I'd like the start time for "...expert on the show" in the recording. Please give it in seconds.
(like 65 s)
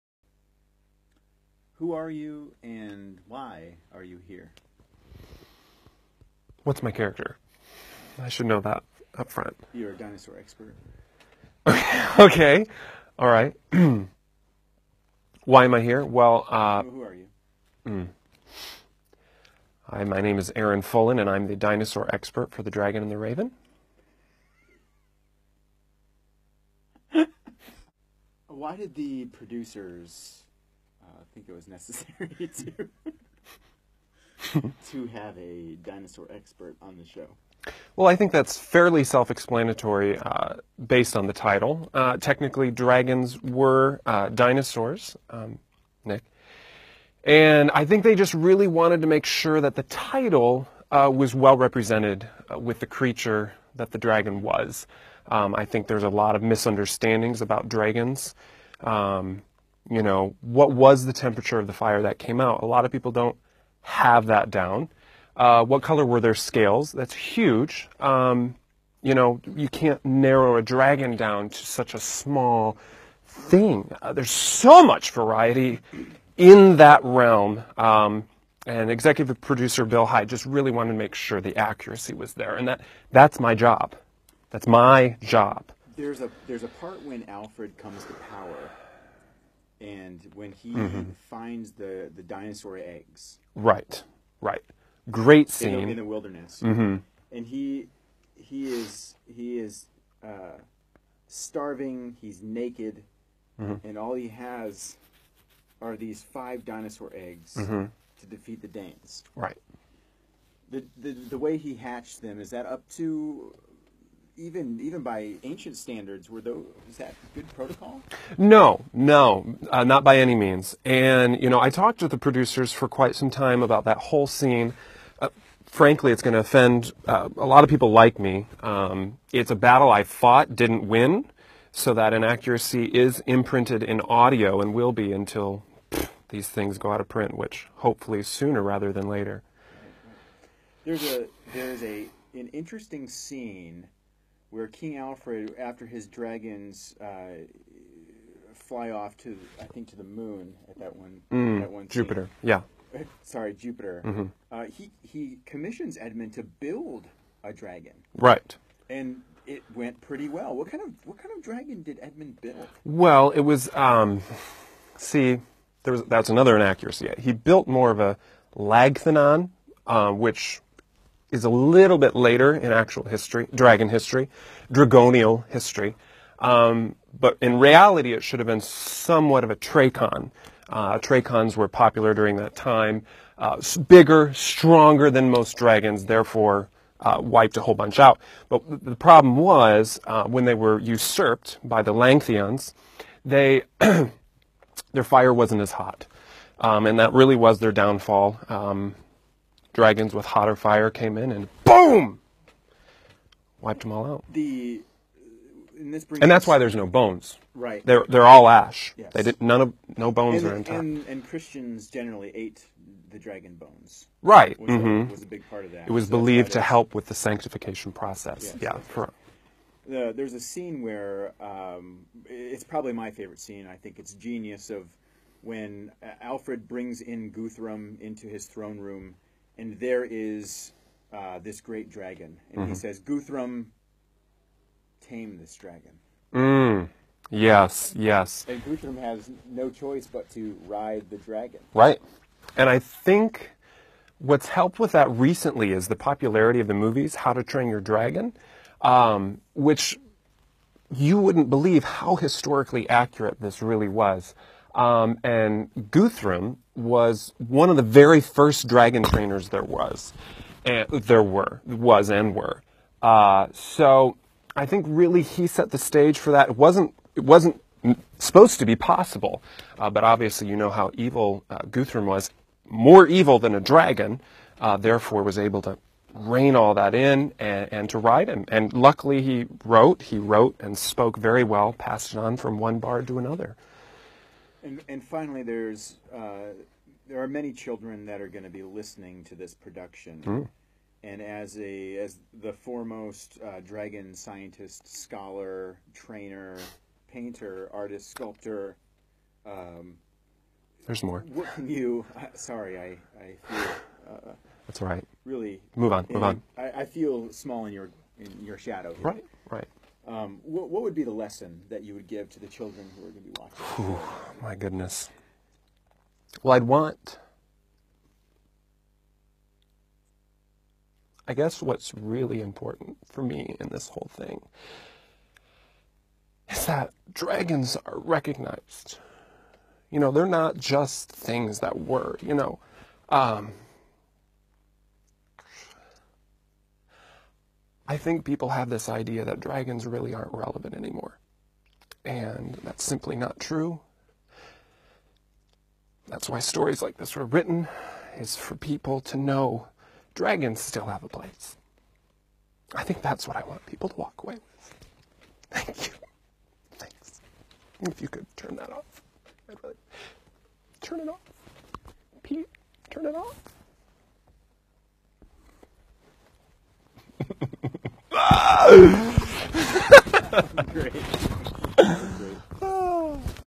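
36 s.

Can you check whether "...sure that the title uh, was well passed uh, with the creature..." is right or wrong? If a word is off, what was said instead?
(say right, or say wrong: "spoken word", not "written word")
wrong: "represented", not "passed".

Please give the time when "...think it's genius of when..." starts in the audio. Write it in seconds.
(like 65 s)
223 s.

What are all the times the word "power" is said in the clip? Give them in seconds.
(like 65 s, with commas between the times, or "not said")
88 s.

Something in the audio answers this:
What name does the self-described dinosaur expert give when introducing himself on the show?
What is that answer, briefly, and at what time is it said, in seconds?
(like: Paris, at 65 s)
Aaron Fullen, at 20 s.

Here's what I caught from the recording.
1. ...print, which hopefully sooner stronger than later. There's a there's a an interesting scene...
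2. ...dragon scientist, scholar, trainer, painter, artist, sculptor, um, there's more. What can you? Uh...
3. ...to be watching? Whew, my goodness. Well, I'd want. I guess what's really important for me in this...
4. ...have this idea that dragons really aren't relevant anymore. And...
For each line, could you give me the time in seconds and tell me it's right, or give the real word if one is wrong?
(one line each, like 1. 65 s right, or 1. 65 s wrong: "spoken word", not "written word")
1. 137 s wrong: "rather", not "stronger"
2. 293 s right
3. 313 s right
4. 338 s right.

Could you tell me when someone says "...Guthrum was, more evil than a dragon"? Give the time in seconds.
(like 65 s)
271 s.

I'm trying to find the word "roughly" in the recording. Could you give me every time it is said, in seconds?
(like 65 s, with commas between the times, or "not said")
not said.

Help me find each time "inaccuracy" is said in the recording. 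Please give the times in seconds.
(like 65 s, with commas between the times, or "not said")
132 s, 166 s.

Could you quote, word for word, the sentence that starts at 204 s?
The and this brings and that's why there's no bones.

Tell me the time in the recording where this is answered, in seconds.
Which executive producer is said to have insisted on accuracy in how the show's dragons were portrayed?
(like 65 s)
79 s.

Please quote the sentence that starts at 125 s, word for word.
Uh, frankly, it's going to offend uh, a lot of people like me.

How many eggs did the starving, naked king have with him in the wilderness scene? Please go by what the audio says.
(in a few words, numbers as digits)
5.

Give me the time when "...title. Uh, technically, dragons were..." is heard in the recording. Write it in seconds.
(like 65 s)
41 s.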